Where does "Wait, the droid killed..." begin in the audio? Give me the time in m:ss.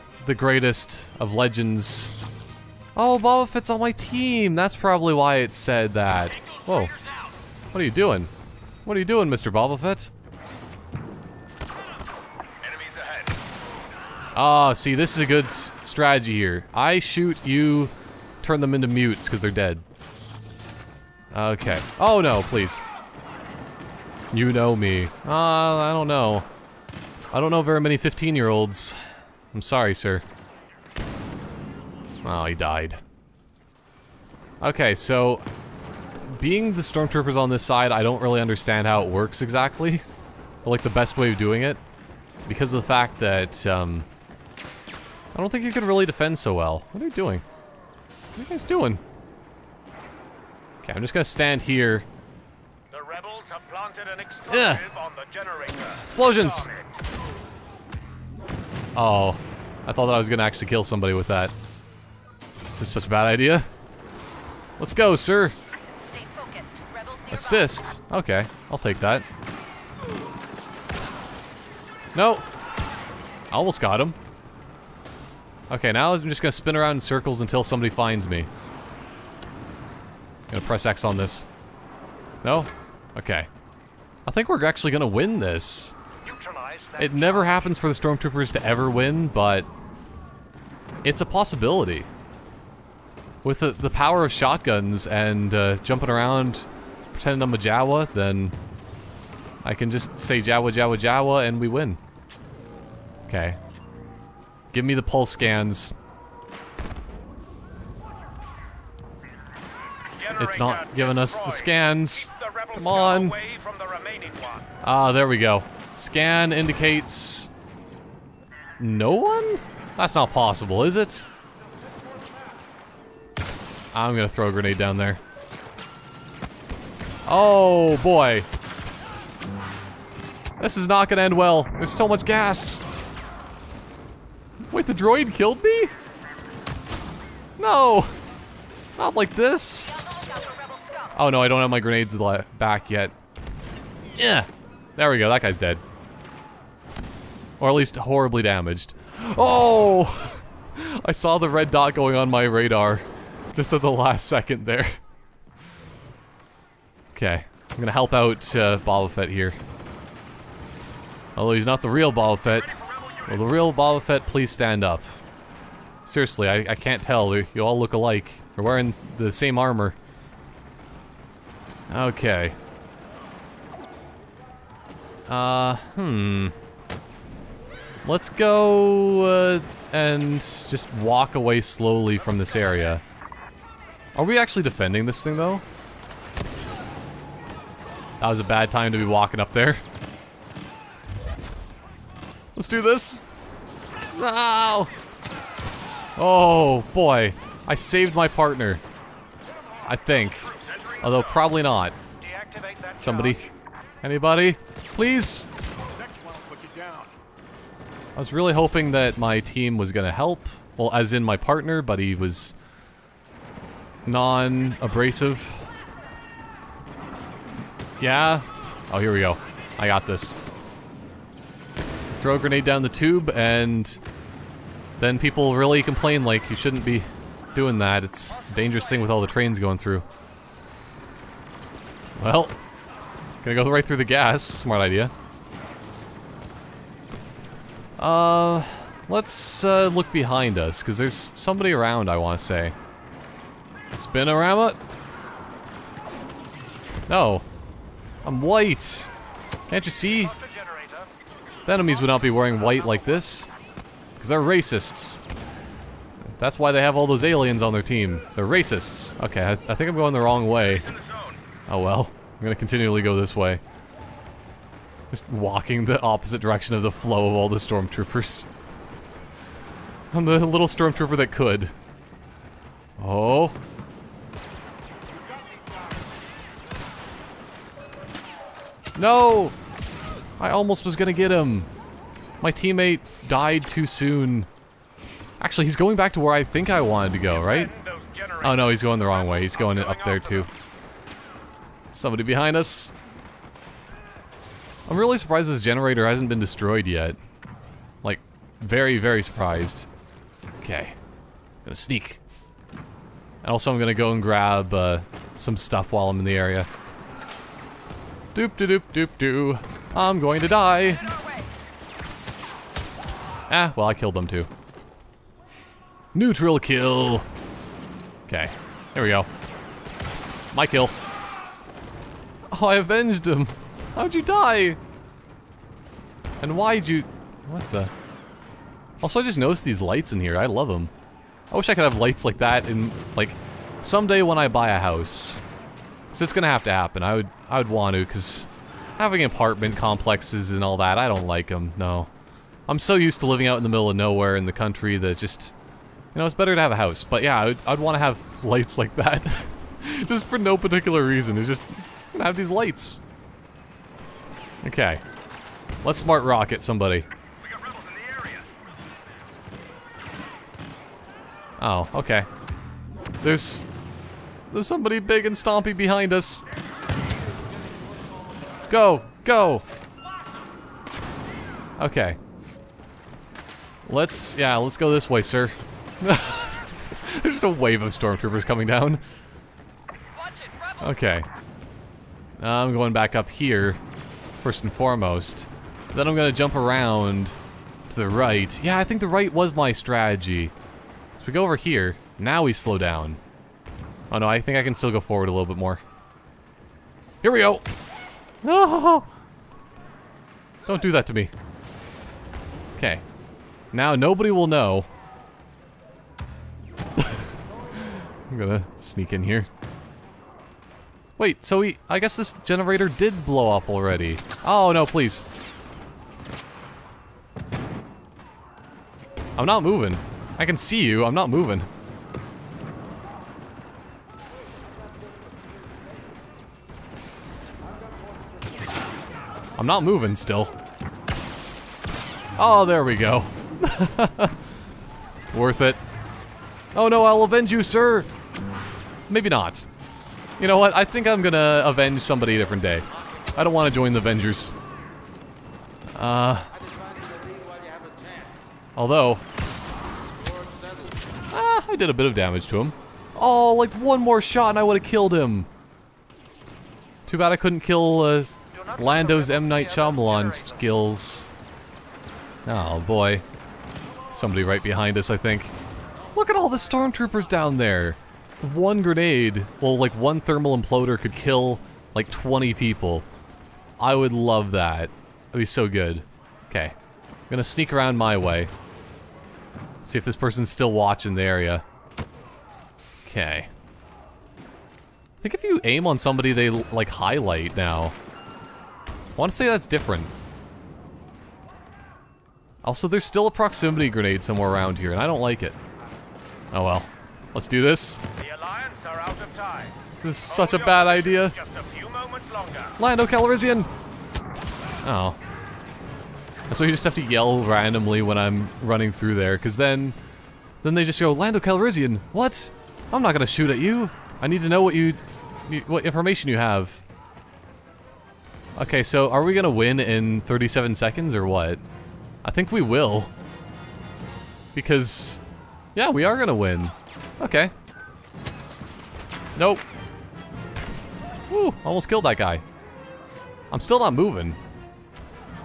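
2:14.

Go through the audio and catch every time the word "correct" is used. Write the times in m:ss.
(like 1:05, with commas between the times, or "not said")
not said.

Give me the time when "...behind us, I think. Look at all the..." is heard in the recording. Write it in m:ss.
7:44.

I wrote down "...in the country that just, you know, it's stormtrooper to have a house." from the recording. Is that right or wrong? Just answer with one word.
wrong.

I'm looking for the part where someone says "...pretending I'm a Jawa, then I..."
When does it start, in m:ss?
1:37.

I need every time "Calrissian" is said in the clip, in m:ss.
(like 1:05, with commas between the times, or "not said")
8:23, 8:31.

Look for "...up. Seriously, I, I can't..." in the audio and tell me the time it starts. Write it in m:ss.
2:44.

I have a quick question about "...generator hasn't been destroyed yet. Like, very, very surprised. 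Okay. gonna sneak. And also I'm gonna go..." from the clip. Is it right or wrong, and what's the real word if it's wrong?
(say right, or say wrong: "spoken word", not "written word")
right.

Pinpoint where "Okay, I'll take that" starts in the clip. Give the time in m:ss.
1:08.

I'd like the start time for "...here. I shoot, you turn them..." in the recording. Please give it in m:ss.
0:16.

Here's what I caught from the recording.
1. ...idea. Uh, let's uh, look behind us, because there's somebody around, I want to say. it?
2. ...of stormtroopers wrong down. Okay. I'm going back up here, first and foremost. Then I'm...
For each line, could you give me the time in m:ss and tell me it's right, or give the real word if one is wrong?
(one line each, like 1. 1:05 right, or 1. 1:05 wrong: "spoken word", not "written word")
1. 3:54 right
2. 6:17 wrong: "coming", not "wrong".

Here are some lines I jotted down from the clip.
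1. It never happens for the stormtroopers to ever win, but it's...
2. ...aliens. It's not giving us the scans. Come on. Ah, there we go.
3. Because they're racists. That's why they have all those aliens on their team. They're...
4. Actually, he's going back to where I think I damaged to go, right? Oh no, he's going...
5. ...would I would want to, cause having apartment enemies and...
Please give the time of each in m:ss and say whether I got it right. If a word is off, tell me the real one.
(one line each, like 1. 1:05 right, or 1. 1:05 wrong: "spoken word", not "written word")
1. 1:26 right
2. 1:45 wrong: "scans", not "aliens"
3. 4:14 right
4. 4:45 wrong: "wanted", not "damaged"
5. 5:37 wrong: "complexes", not "enemies".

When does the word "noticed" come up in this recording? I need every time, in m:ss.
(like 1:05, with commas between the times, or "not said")
5:29.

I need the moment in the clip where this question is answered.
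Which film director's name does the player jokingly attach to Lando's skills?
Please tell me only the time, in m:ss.
7:39.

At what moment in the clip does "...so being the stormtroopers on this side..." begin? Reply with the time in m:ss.
0:34.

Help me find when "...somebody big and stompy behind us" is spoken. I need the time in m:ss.
6:04.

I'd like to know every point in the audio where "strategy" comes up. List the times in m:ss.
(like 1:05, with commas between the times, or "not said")
0:15, 6:29.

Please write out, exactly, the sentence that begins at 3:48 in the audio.
It's a dangerous thing with all the trains going through.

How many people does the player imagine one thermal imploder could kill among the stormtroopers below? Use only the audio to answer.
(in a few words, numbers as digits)
20.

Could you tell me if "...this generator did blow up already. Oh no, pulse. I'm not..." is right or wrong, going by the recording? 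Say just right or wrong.
wrong.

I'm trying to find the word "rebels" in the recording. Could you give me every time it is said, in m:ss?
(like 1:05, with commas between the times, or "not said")
0:53.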